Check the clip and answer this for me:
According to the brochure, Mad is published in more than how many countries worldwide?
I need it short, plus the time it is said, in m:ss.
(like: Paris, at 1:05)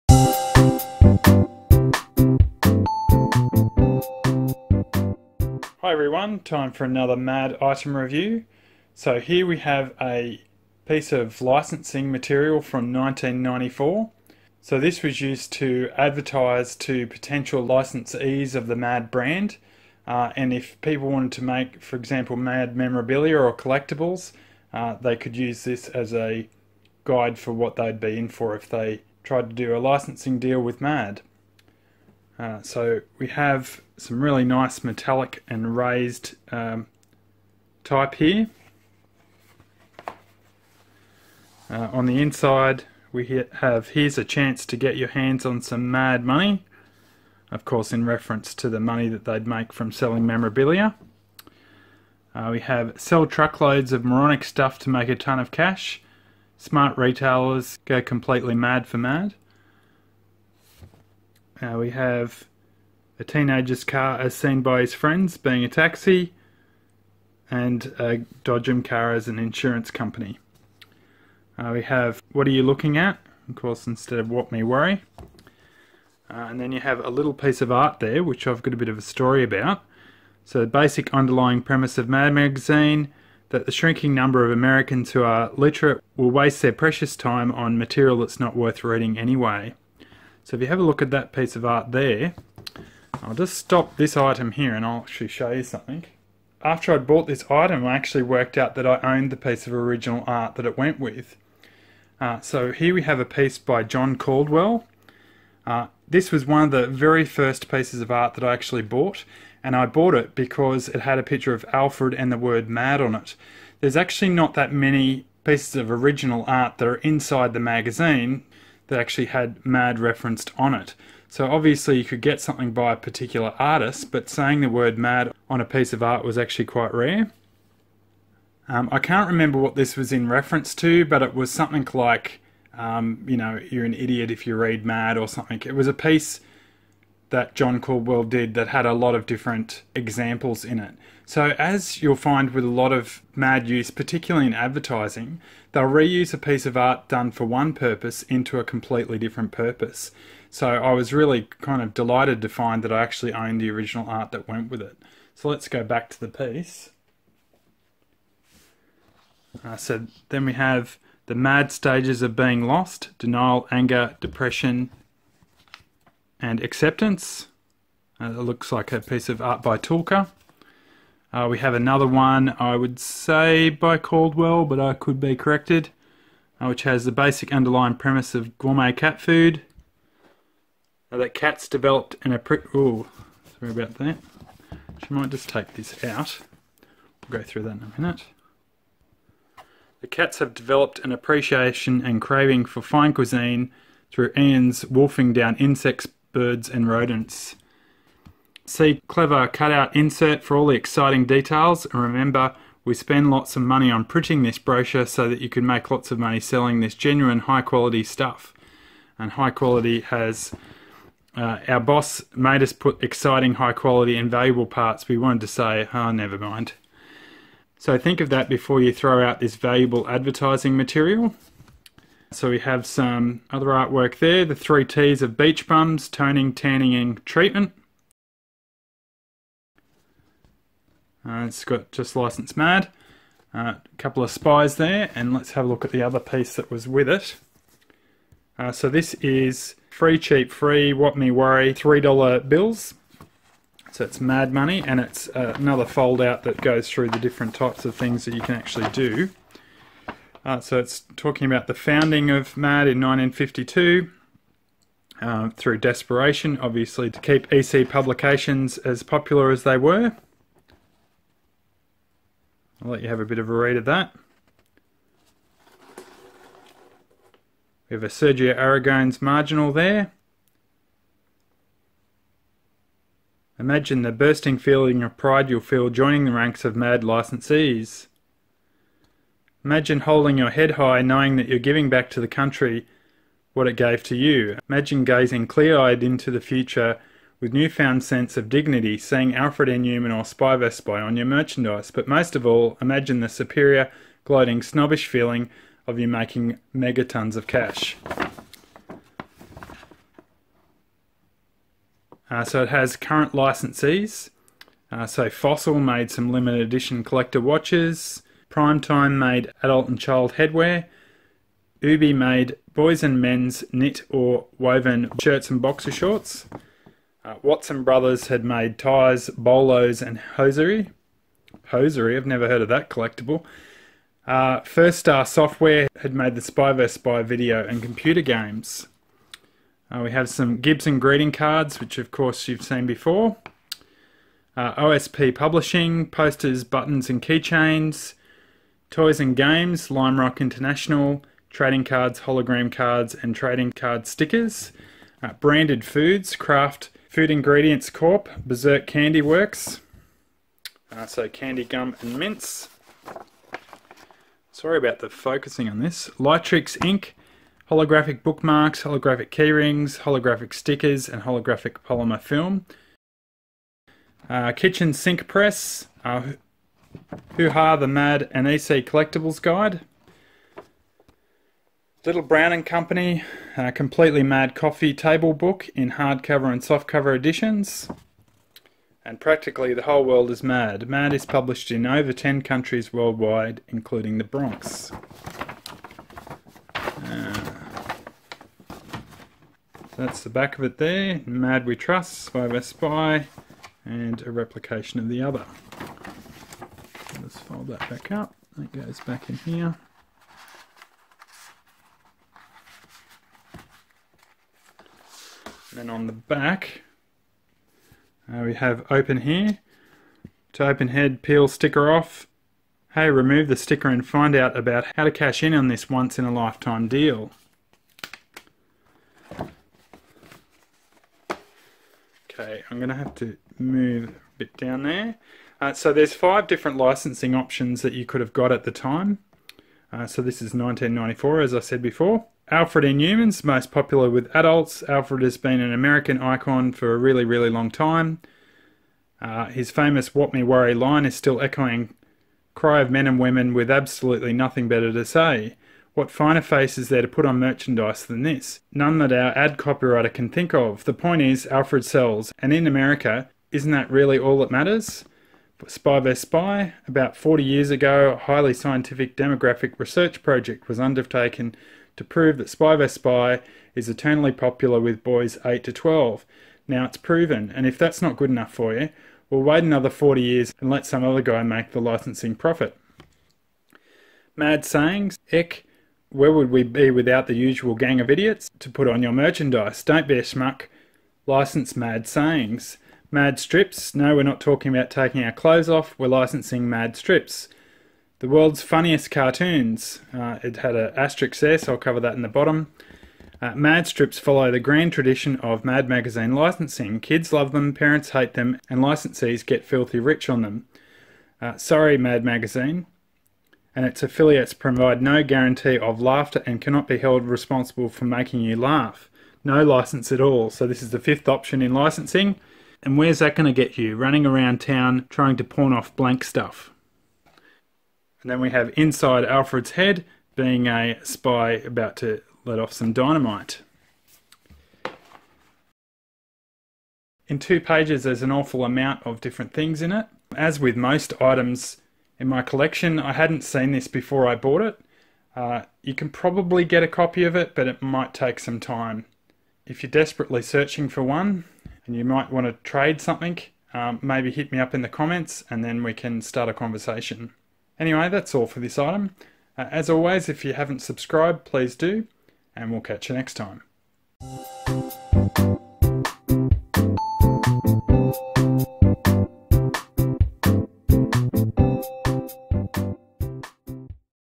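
10, at 6:22.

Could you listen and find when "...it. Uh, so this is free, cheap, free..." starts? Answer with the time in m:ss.
3:57.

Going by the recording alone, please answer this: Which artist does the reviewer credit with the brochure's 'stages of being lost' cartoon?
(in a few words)
Tulka.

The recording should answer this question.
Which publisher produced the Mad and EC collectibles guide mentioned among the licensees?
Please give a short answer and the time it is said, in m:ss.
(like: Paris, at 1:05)
Kitchen Sink Press, at 6:04.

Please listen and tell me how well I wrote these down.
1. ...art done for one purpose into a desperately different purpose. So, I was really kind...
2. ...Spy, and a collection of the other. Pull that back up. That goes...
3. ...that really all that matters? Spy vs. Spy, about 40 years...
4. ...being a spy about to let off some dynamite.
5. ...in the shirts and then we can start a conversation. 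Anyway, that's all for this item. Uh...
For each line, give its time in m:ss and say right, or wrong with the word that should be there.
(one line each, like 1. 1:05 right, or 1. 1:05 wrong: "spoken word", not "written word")
1. 2:26 wrong: "completely", not "desperately"
2. 6:32 wrong: "replication", not "collection"
3. 7:33 right
4. 8:40 right
5. 9:04 wrong: "comments", not "shirts".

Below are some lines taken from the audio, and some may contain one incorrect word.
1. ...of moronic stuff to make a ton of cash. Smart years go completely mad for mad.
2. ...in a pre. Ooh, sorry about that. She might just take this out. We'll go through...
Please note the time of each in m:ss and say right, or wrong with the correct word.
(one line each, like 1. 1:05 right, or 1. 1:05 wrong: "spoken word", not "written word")
1. 0:53 wrong: "retailers", not "years"
2. 3:02 right.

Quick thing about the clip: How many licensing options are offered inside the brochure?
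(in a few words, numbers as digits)
5.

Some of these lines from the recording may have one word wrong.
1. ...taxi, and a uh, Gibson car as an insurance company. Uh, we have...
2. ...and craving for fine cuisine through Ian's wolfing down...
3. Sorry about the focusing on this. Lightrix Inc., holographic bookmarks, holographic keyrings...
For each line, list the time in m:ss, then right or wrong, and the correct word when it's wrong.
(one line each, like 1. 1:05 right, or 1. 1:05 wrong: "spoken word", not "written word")
1. 1:05 wrong: "Dodgem", not "Gibson"
2. 3:12 right
3. 5:54 right.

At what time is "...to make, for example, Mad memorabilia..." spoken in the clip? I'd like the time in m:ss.
0:21.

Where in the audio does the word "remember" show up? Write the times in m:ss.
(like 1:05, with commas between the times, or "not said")
2:09, 3:22.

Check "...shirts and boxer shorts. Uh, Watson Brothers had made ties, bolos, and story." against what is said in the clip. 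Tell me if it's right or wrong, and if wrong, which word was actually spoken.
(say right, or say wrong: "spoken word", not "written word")
wrong: "hosiery", not "story".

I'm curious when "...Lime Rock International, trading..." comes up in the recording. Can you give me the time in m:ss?
5:39.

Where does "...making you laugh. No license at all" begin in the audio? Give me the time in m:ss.
8:28.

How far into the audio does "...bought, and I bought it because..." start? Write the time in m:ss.
1:48.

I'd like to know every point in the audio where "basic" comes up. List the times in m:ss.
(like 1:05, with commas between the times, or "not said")
1:20, 2:57.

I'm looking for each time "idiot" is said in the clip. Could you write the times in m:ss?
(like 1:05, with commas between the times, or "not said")
2:13, 7:58.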